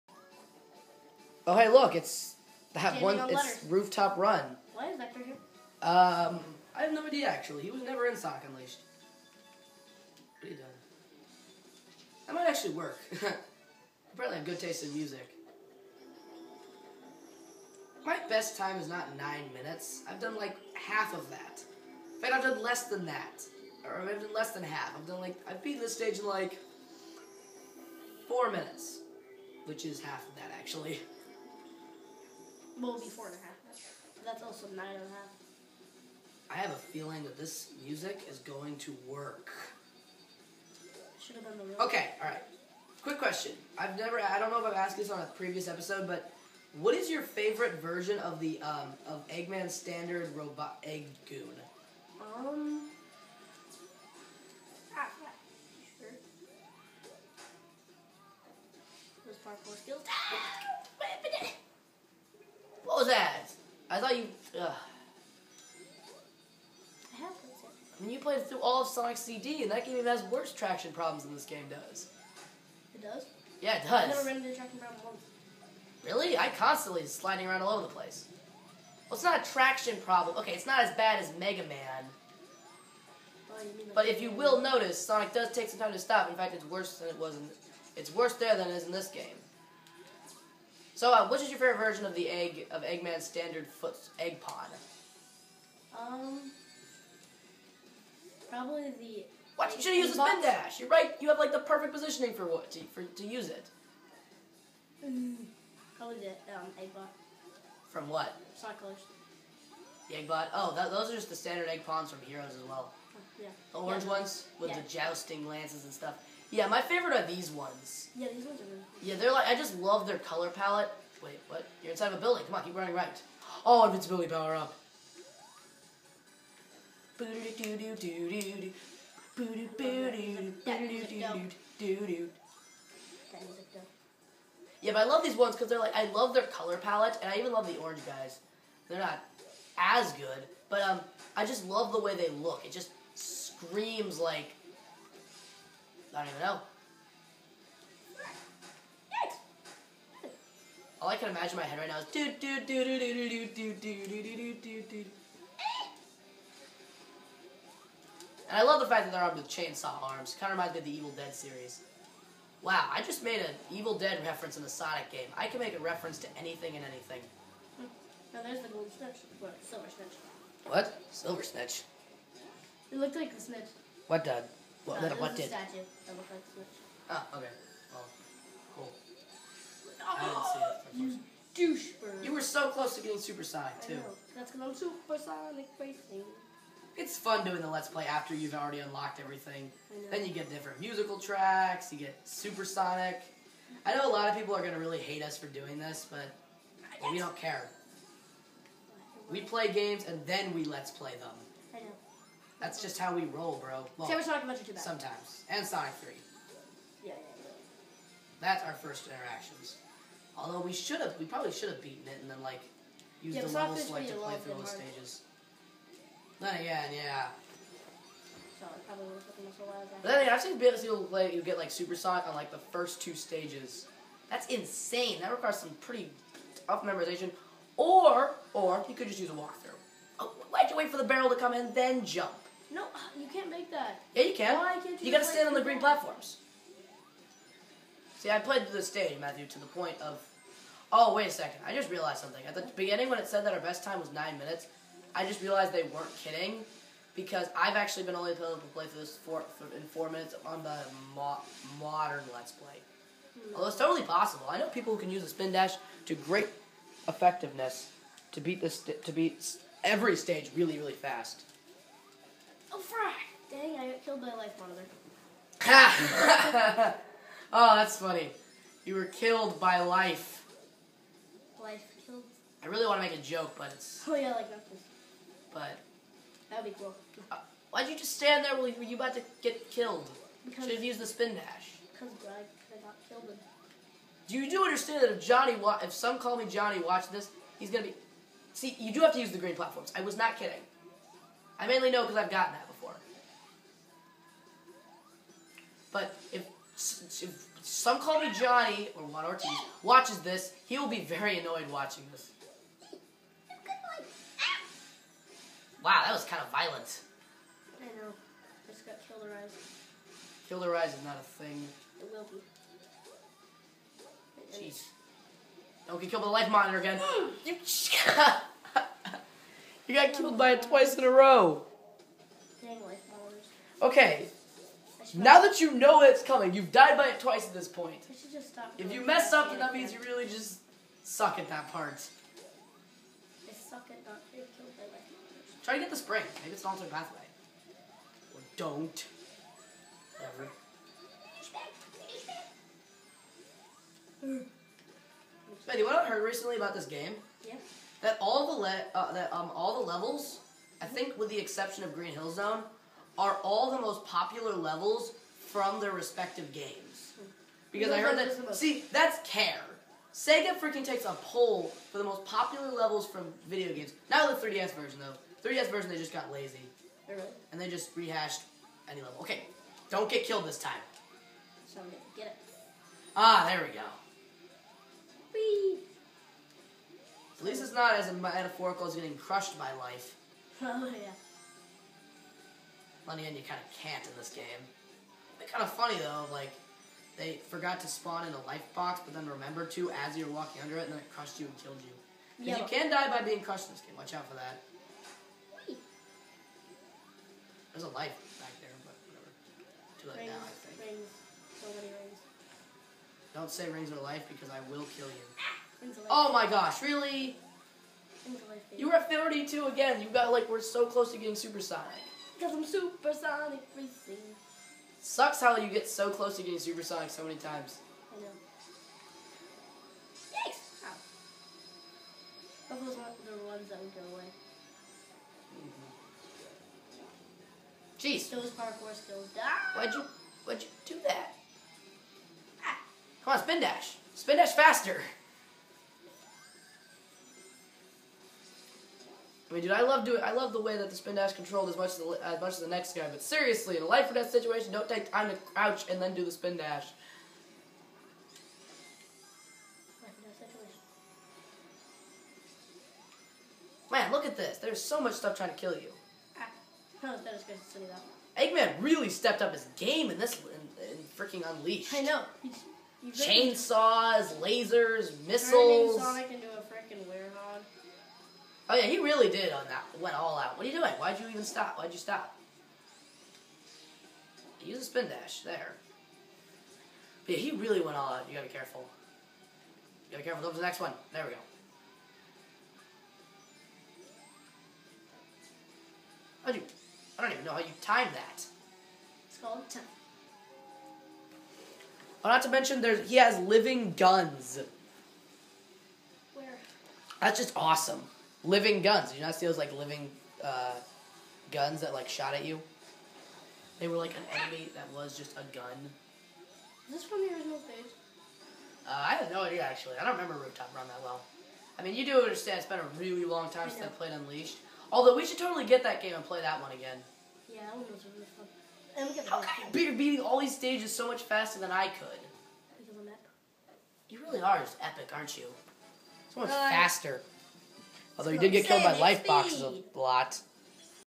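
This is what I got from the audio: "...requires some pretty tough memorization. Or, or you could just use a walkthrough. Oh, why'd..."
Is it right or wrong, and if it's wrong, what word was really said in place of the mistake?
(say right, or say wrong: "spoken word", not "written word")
right.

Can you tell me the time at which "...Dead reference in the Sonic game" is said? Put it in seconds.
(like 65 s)
163 s.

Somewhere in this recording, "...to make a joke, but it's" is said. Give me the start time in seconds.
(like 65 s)
273 s.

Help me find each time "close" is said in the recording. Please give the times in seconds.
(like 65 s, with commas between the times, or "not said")
182 s, 410 s, 416 s.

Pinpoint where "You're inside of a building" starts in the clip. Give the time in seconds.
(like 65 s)
121 s.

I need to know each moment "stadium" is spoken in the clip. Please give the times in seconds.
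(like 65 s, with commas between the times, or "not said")
238 s.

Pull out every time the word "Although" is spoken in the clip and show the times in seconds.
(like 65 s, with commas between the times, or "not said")
210 s, 253 s, 514 s, 528 s.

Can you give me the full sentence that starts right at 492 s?
Oh, not to mention, there's he has living guns.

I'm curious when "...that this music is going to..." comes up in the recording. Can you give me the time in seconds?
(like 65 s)
37 s.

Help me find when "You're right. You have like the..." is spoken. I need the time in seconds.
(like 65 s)
100 s.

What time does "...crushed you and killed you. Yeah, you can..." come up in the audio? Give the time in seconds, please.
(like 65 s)
391 s.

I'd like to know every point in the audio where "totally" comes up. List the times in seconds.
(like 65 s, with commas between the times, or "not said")
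253 s, 515 s.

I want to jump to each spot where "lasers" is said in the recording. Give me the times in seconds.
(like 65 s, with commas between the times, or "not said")
464 s.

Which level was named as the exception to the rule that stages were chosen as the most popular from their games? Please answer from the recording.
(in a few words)
Green Hill Zone.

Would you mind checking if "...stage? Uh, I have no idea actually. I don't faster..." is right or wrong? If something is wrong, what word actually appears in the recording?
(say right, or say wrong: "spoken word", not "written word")
wrong: "remember", not "faster".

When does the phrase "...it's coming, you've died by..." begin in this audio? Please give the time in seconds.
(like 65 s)
326 s.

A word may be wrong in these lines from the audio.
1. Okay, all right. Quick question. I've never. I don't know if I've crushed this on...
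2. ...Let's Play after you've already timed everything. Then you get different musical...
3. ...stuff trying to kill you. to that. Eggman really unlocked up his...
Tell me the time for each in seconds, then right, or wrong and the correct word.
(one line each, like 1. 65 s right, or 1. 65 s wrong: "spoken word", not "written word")
1. 41 s wrong: "asked", not "crushed"
2. 187 s wrong: "unlocked", not "timed"
3. 455 s wrong: "stepped", not "unlocked".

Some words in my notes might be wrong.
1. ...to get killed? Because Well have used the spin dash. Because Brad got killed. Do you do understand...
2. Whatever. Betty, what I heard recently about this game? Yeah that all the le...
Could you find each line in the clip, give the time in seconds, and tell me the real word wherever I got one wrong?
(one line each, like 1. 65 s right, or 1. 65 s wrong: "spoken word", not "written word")
1. 279 s wrong: "Should", not "Well"
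2. 340 s right.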